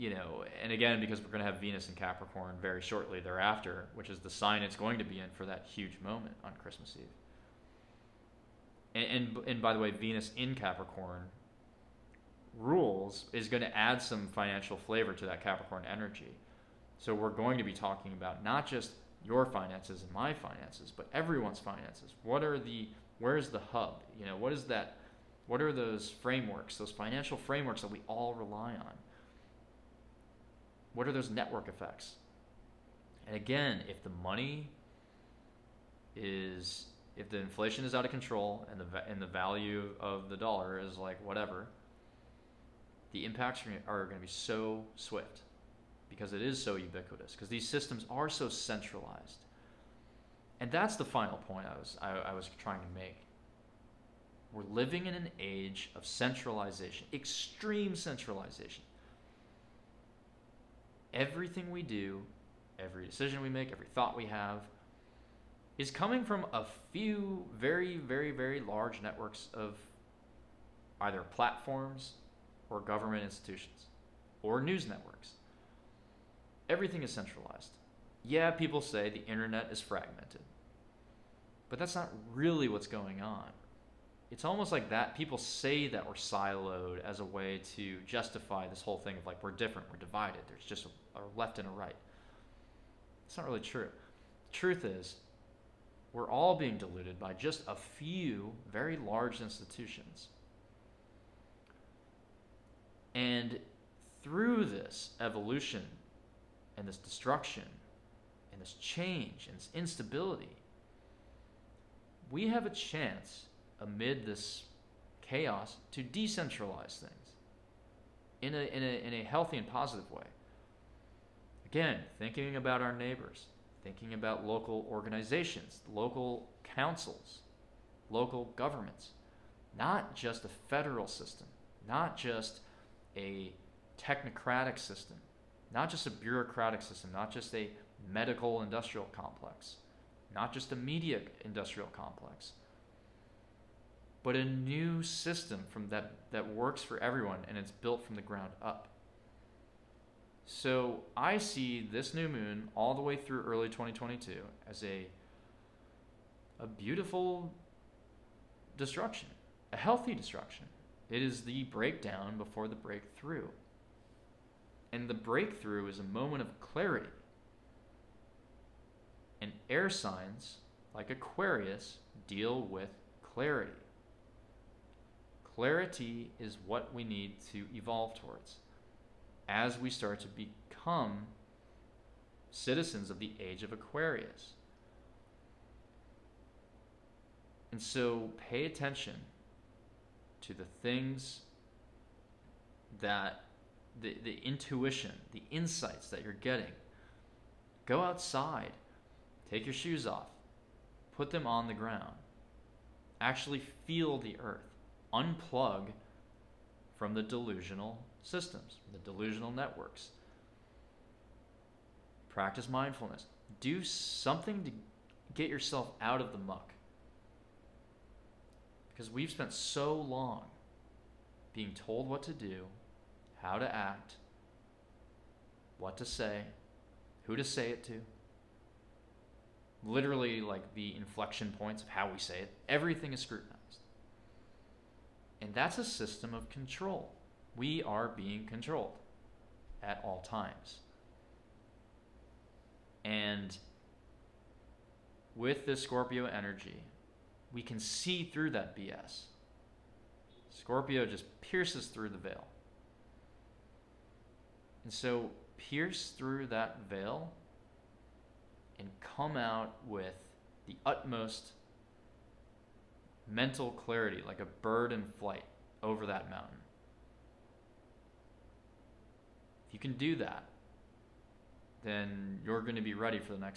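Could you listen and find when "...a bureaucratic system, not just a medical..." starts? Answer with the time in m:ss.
2:16.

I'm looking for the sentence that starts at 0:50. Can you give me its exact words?
And that's the final point I was, I, I was trying to make.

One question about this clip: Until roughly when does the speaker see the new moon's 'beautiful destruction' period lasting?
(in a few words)
Early 2022.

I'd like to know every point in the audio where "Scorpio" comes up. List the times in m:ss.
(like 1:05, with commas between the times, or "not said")
4:05, 4:10.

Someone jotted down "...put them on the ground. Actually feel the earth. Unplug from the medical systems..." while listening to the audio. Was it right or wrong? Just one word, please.
wrong.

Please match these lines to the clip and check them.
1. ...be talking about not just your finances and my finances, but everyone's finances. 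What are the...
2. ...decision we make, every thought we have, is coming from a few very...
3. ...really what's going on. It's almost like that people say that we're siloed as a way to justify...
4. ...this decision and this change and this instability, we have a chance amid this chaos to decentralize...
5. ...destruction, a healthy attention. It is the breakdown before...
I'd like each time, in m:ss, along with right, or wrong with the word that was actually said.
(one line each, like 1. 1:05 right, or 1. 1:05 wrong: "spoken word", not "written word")
1. 0:17 right
2. 1:03 right
3. 1:22 right
4. 1:46 wrong: "destruction", not "decision"
5. 2:38 wrong: "destruction", not "attention".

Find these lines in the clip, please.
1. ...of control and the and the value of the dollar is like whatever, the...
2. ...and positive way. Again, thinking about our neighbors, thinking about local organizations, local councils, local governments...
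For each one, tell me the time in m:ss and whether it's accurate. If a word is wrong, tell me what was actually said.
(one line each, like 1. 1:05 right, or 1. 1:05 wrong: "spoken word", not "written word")
1. 0:38 right
2. 1:59 right.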